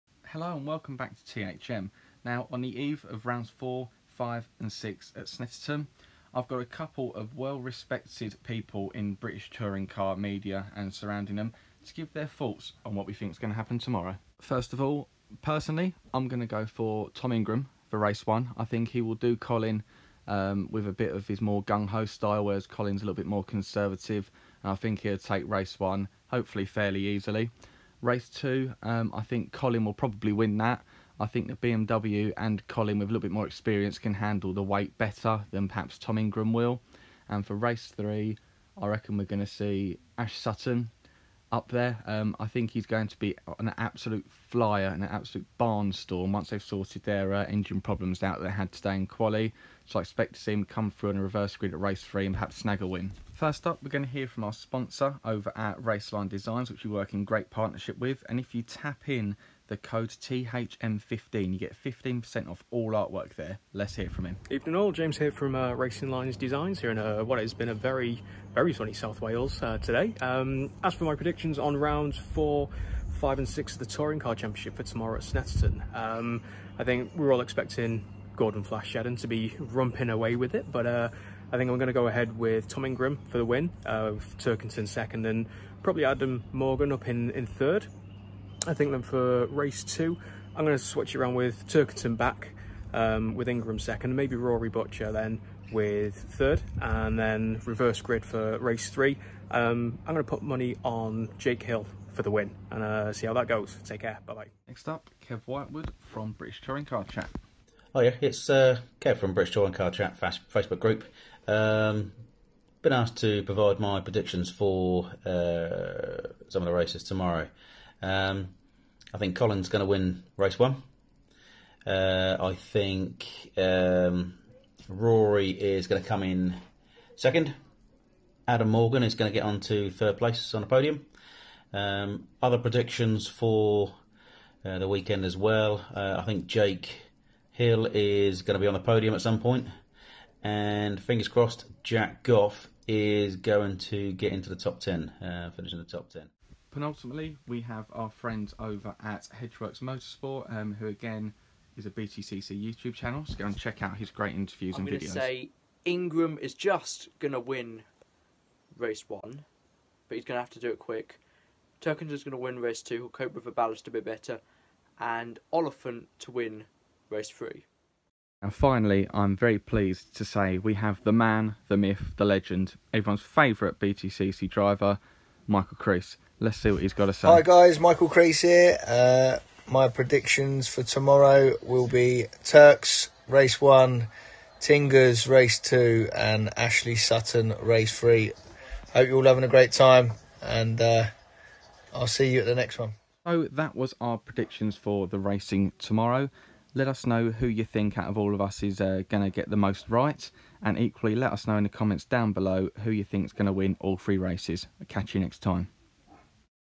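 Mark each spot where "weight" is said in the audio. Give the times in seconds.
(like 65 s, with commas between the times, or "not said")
34 s.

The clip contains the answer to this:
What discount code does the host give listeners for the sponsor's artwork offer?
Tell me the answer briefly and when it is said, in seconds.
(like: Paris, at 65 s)
THM15, at 60 s.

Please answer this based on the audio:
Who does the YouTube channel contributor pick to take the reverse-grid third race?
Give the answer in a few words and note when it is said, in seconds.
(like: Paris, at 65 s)
Oliphant, at 165 s.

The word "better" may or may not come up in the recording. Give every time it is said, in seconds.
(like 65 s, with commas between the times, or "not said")
34 s, 164 s.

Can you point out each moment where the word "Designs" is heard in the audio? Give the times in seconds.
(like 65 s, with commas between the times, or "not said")
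56 s, 66 s.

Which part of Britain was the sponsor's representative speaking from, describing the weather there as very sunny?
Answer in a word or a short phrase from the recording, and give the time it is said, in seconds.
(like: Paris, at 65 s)
South Wales, at 68 s.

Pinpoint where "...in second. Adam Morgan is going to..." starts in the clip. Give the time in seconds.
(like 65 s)
126 s.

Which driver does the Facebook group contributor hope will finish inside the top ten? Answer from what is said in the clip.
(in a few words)
Jack Goff.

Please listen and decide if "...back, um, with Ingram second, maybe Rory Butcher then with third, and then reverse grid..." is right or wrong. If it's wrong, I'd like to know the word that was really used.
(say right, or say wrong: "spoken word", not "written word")
right.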